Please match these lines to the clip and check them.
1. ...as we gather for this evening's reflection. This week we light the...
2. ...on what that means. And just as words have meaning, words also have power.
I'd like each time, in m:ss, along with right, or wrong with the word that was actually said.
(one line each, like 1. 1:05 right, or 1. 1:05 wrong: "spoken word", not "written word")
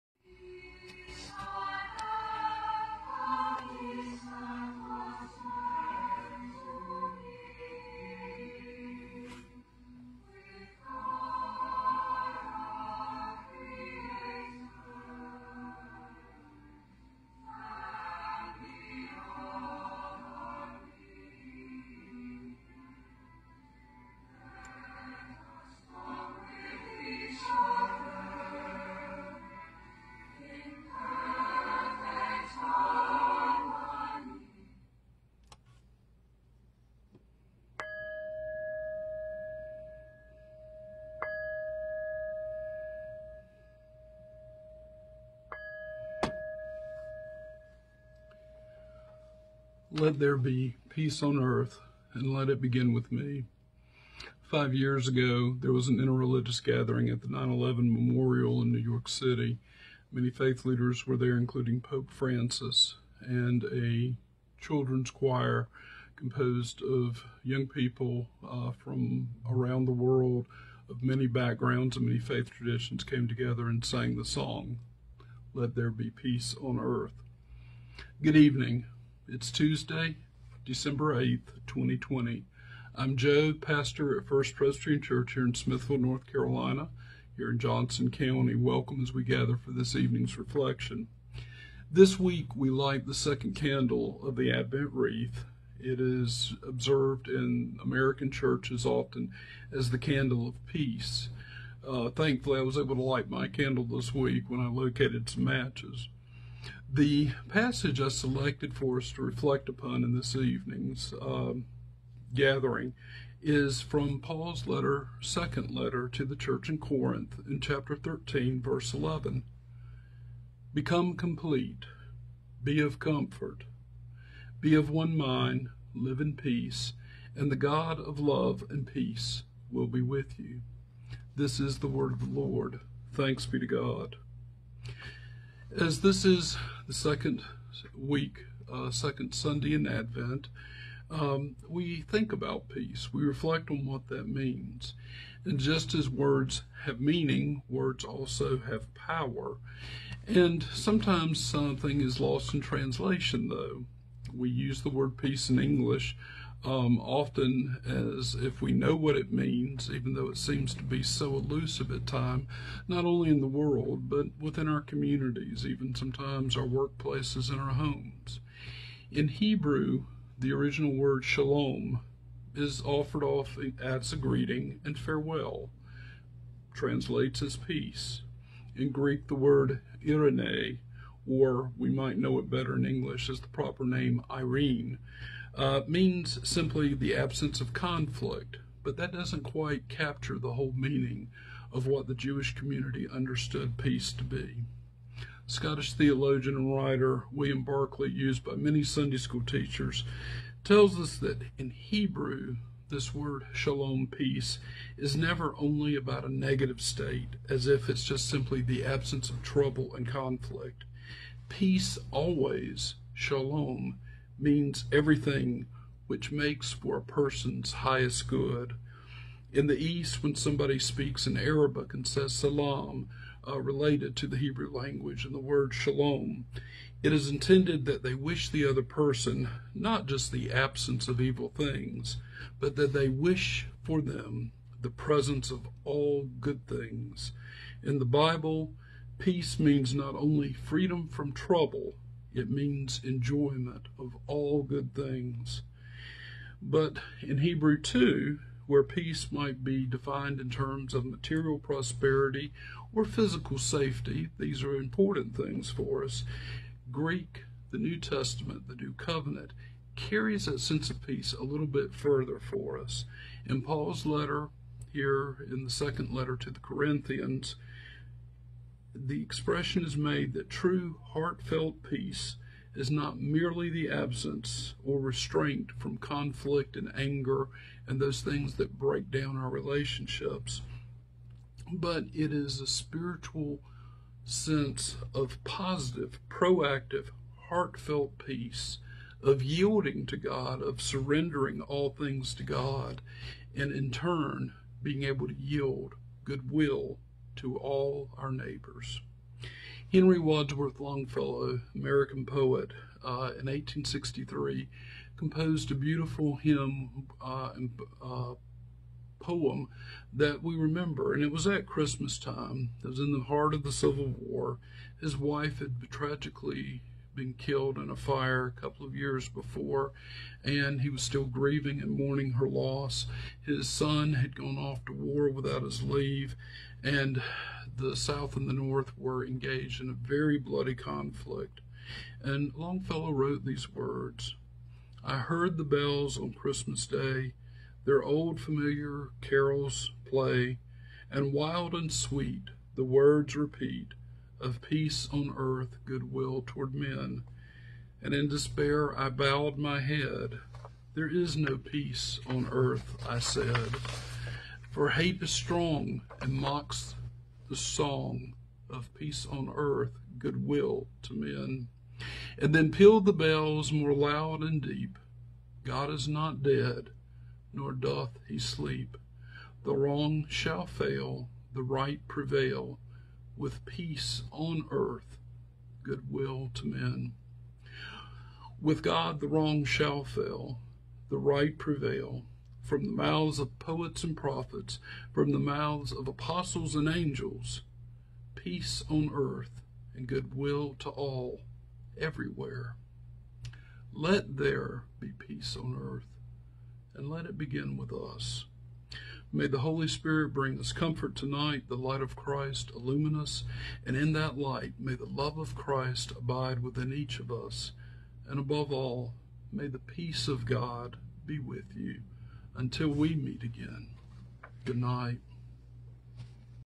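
1. 1:29 right
2. 2:23 right.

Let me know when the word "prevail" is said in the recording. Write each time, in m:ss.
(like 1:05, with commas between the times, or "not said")
6:12, 6:21.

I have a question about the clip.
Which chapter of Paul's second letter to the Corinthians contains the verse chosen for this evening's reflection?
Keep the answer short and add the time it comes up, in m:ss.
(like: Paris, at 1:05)
13, at 1:57.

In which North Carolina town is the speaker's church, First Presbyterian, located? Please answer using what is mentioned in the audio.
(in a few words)
Smithfield.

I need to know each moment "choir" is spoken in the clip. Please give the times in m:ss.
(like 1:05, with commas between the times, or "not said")
1:05.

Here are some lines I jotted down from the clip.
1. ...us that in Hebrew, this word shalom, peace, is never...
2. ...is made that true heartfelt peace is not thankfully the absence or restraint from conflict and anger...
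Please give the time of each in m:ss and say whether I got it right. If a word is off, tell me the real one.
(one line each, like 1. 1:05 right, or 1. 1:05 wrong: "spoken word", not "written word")
1. 3:20 right
2. 4:29 wrong: "merely", not "thankfully".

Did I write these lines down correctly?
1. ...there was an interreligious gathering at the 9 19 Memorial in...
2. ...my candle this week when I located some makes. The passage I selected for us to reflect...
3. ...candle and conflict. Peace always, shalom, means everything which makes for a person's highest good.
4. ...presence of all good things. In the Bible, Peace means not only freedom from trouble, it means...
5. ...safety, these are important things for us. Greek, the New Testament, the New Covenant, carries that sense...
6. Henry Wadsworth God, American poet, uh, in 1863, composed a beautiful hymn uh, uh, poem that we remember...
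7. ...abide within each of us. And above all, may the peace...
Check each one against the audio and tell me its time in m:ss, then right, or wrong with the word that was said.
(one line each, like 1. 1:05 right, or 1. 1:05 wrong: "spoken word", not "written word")
1. 0:55 wrong: "11", not "19"
2. 1:43 wrong: "matches", not "makes"
3. 3:29 wrong: "trouble", not "candle"
4. 3:54 right
5. 4:13 right
6. 4:59 wrong: "Longfellow", not "God"
7. 6:46 right.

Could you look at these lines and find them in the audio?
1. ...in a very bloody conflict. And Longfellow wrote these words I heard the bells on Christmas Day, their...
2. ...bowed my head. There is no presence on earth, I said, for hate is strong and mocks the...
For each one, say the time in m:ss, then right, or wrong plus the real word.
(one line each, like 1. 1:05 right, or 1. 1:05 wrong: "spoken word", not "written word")
1. 5:29 right
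2. 5:49 wrong: "peace", not "presence".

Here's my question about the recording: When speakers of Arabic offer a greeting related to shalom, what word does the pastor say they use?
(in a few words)
salam.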